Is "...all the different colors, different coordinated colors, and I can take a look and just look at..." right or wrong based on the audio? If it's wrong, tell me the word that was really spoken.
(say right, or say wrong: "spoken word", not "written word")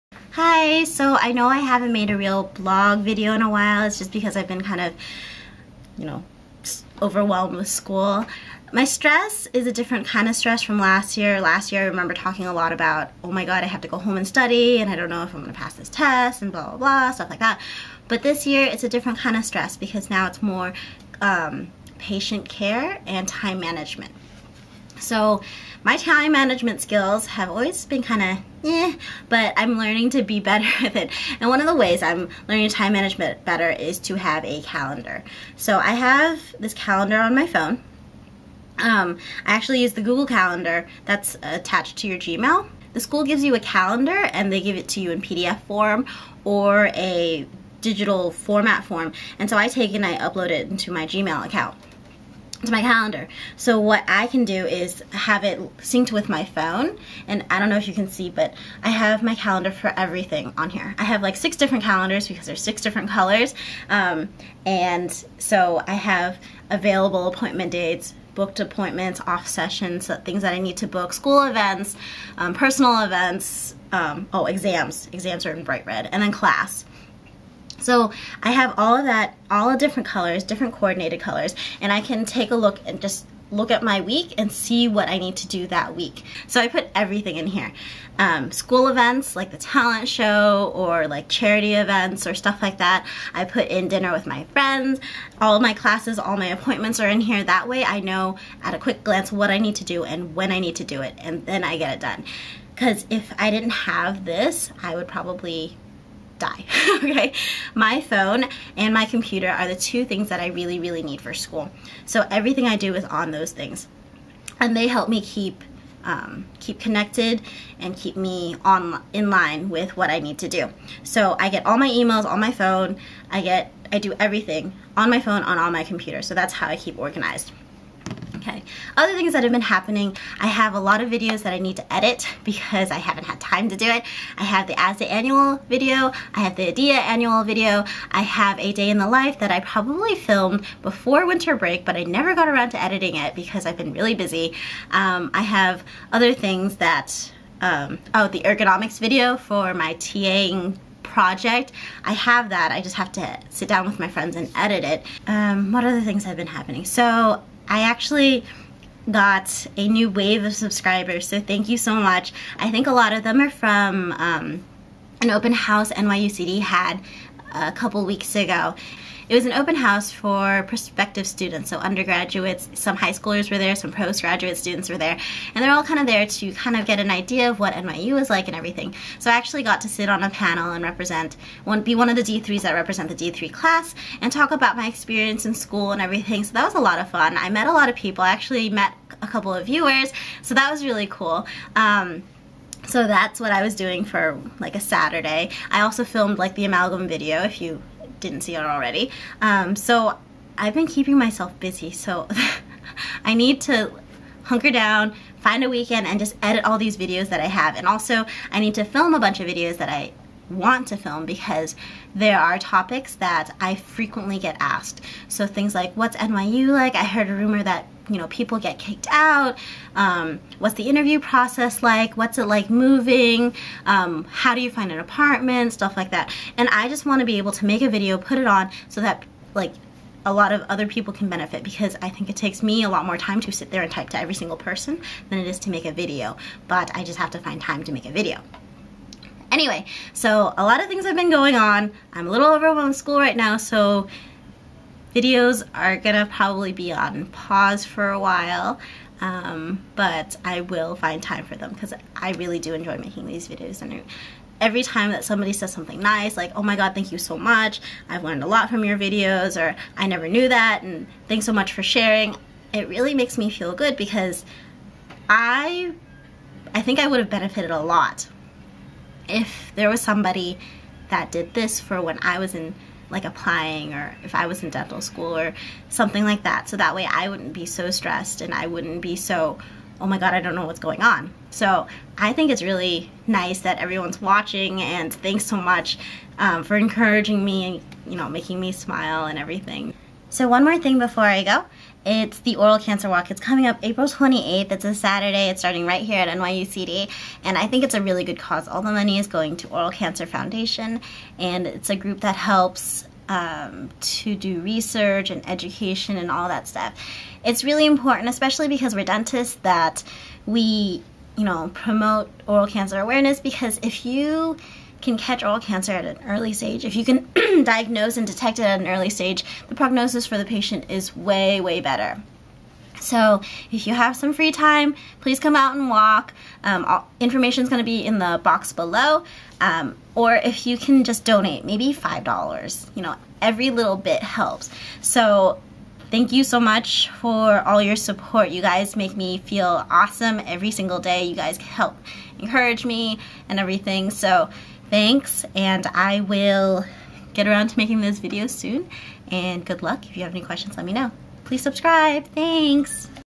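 right.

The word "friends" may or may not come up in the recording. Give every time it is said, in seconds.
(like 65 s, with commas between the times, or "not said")
94 s, 154 s.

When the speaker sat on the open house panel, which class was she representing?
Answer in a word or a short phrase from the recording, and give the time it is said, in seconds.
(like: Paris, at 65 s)
D3 class, at 183 s.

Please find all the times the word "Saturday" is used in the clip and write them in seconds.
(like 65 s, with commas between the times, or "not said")
194 s, 294 s.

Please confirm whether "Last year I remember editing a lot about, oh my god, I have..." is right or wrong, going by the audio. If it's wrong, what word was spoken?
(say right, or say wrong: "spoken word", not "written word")
wrong: "talking", not "editing".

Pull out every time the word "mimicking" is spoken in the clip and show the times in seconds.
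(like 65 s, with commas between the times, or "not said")
not said.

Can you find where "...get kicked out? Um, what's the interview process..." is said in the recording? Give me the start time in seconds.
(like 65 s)
218 s.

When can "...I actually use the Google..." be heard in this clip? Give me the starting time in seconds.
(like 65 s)
39 s.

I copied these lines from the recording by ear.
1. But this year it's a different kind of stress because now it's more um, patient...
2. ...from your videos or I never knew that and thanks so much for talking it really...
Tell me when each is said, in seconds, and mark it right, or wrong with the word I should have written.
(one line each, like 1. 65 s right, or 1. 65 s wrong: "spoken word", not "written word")
1. 18 s right
2. 258 s wrong: "sharing", not "talking".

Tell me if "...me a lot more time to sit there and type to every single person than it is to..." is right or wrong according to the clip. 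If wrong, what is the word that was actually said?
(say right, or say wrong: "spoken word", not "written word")
right.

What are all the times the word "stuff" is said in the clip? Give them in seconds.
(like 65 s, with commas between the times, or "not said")
17 s, 92 s, 225 s, 306 s.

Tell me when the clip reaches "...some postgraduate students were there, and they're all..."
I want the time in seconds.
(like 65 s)
173 s.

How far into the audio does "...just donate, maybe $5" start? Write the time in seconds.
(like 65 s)
331 s.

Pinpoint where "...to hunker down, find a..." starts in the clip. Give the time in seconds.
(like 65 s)
203 s.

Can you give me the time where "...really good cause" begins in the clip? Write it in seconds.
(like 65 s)
298 s.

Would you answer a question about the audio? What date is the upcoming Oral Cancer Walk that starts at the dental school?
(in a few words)
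April 28th.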